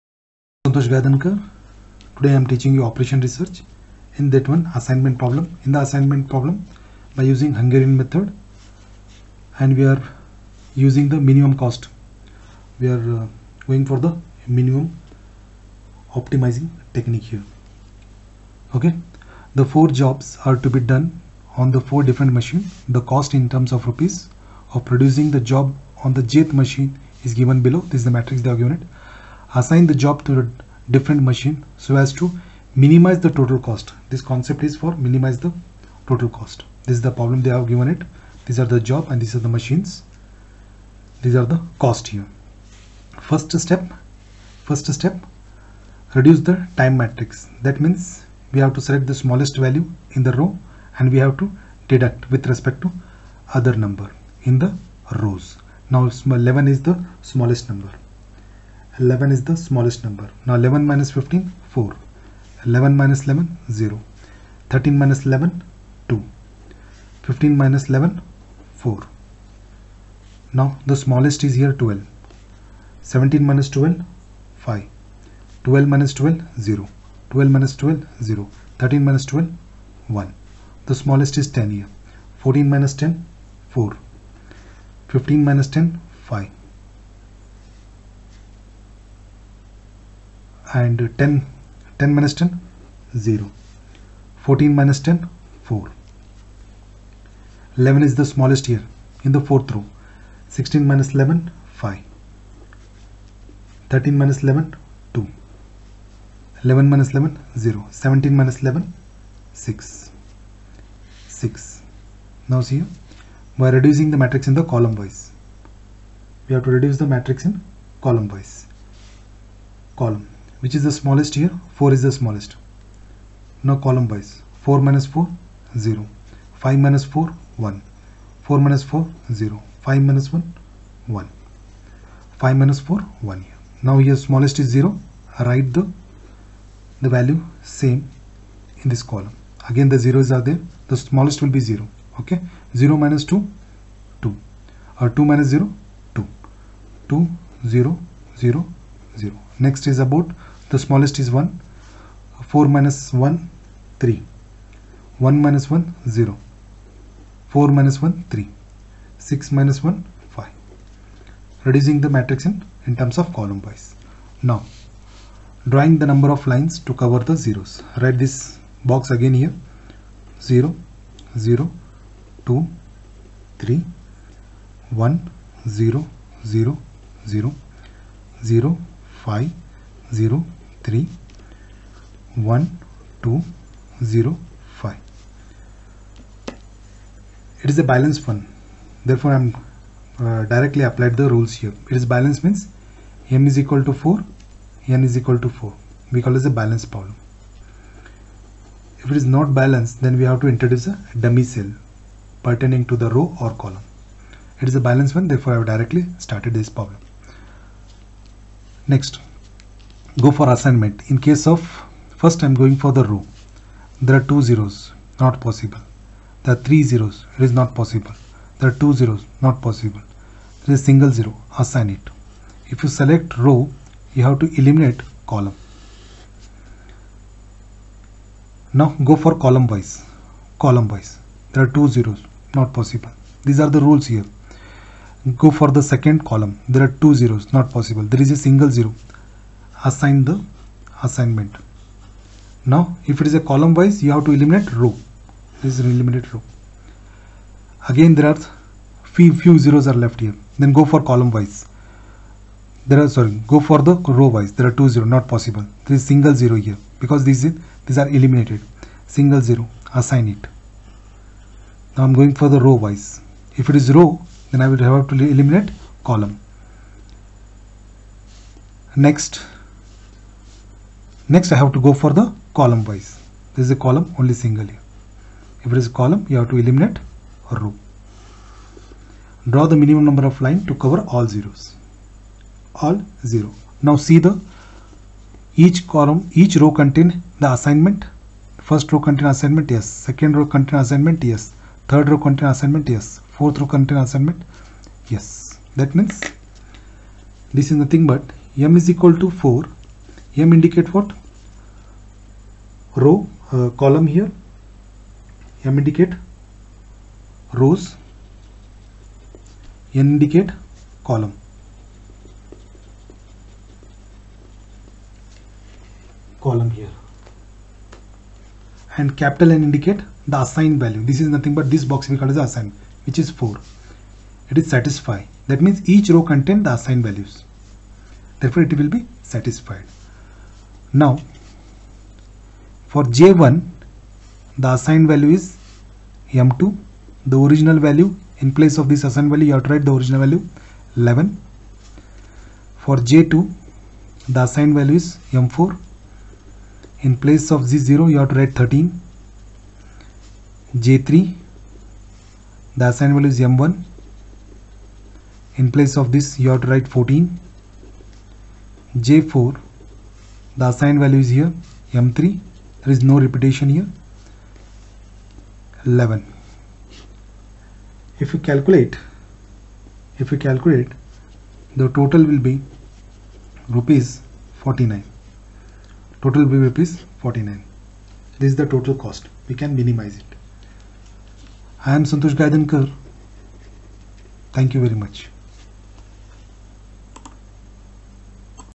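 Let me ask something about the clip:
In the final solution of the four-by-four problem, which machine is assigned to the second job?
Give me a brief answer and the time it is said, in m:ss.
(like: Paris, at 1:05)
M4, at 5:45.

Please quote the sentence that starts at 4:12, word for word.
There are sorry, go for the row wise.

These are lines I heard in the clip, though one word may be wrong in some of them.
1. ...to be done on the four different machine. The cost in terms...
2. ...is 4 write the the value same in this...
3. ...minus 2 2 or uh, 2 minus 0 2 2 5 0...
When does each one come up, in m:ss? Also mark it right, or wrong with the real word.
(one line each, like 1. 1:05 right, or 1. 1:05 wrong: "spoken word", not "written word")
1. 0:20 right
2. 2:14 wrong: "0", not "4"
3. 2:23 wrong: "0", not "5".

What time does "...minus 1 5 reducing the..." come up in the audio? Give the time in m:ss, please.
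2:39.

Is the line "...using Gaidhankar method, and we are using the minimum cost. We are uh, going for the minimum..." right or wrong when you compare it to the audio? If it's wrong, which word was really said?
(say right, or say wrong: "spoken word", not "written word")
wrong: "Hungarian", not "Gaidhankar".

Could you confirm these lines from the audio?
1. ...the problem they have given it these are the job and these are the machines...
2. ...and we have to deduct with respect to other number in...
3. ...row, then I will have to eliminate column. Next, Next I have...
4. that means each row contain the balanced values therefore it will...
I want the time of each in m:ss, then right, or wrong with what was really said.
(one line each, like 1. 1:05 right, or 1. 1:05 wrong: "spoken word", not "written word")
1. 0:37 right
2. 0:50 right
3. 4:23 right
4. 5:25 wrong: "assigned", not "balanced".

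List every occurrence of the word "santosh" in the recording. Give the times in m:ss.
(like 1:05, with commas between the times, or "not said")
0:00, 6:22.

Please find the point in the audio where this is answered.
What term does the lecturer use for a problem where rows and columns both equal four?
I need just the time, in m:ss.
3:16.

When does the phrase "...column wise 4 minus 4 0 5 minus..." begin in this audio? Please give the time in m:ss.
2:03.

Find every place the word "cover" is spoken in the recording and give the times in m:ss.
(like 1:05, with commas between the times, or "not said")
2:47, 4:40.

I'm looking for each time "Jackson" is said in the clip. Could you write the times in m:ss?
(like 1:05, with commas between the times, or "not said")
not said.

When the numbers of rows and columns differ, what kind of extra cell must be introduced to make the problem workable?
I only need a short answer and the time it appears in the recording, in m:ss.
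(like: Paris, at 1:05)
dummy cell, at 3:21.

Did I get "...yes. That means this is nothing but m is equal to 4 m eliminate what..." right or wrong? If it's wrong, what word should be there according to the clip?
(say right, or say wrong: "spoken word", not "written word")
wrong: "indicate", not "eliminate".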